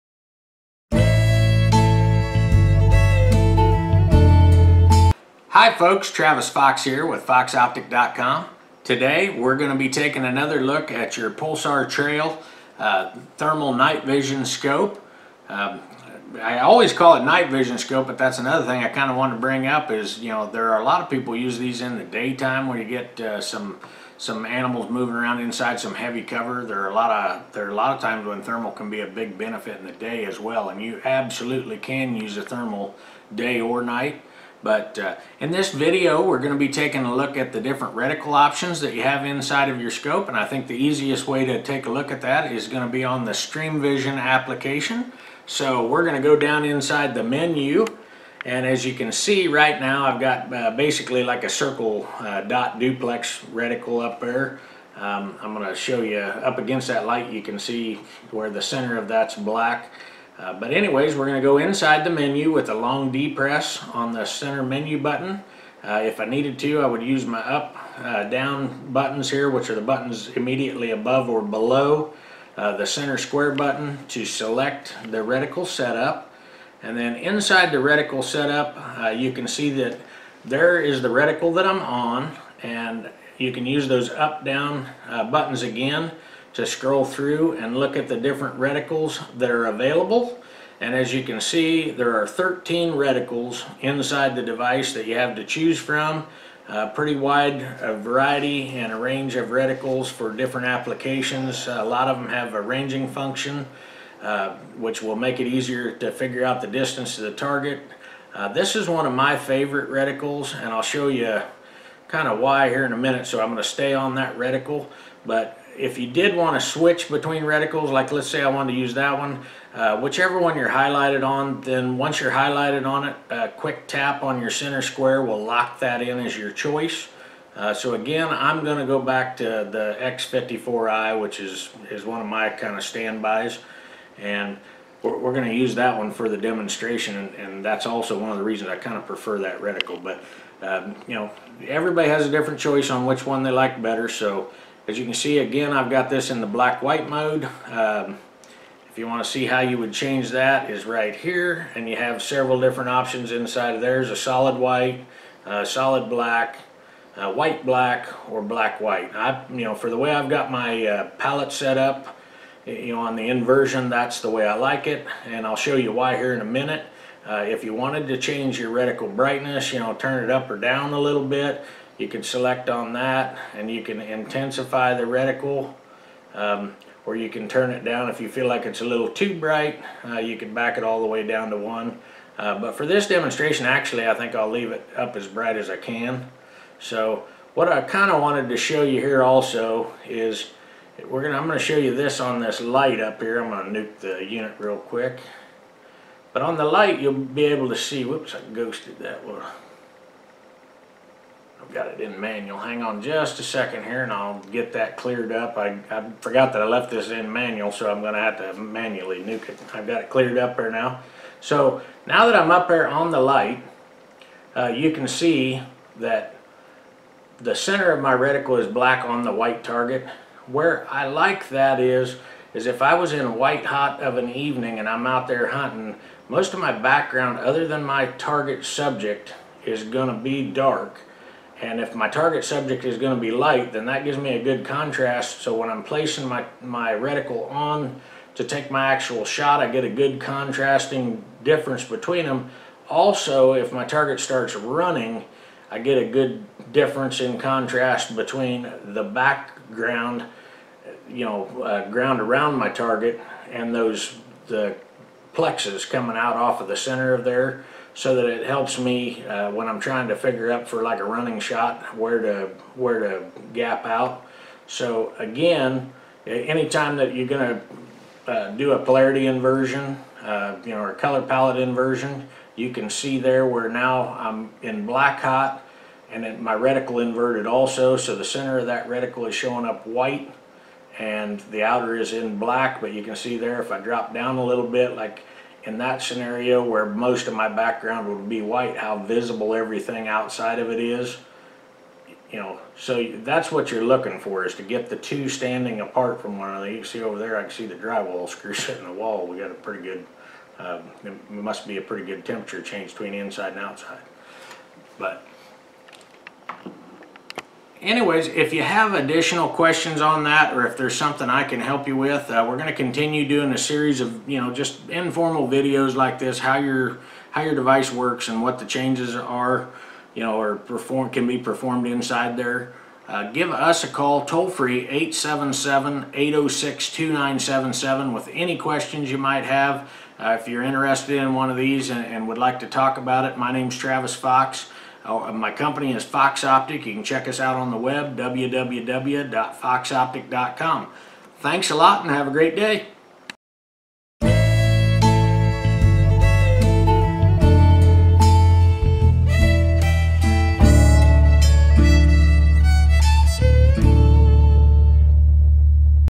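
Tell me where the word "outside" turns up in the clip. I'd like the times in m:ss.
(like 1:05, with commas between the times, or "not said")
4:50, 5:03.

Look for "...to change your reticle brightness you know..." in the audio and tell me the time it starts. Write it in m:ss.
2:48.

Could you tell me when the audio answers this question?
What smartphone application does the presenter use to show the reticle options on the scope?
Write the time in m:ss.
0:43.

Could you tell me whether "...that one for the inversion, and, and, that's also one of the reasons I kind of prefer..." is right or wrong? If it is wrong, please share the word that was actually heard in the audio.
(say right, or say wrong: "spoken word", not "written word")
wrong: "demonstration", not "inversion".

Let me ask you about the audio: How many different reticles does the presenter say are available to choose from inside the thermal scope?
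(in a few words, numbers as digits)
13.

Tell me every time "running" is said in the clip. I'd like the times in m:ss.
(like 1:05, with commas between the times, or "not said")
4:04, 4:21.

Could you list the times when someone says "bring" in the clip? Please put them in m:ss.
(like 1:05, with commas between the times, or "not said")
0:19.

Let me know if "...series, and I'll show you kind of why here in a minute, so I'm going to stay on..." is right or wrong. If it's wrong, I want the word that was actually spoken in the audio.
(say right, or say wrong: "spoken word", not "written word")
wrong: "reticles", not "series".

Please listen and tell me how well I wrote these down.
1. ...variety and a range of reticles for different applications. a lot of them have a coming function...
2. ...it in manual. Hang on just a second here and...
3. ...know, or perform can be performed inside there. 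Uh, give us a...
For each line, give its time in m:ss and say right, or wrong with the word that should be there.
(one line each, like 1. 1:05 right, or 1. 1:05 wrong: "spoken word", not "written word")
1. 1:37 wrong: "ranging", not "coming"
2. 3:21 right
3. 5:20 right.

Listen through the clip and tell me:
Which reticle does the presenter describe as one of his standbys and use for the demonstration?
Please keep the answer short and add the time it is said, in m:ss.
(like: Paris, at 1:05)
X54i, at 2:09.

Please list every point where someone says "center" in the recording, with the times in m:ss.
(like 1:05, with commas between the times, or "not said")
0:58, 1:04, 1:12, 2:04, 3:37, 4:16, 4:38.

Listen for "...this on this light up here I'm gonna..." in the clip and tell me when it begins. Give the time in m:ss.
3:11.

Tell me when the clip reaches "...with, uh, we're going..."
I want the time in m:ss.
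5:11.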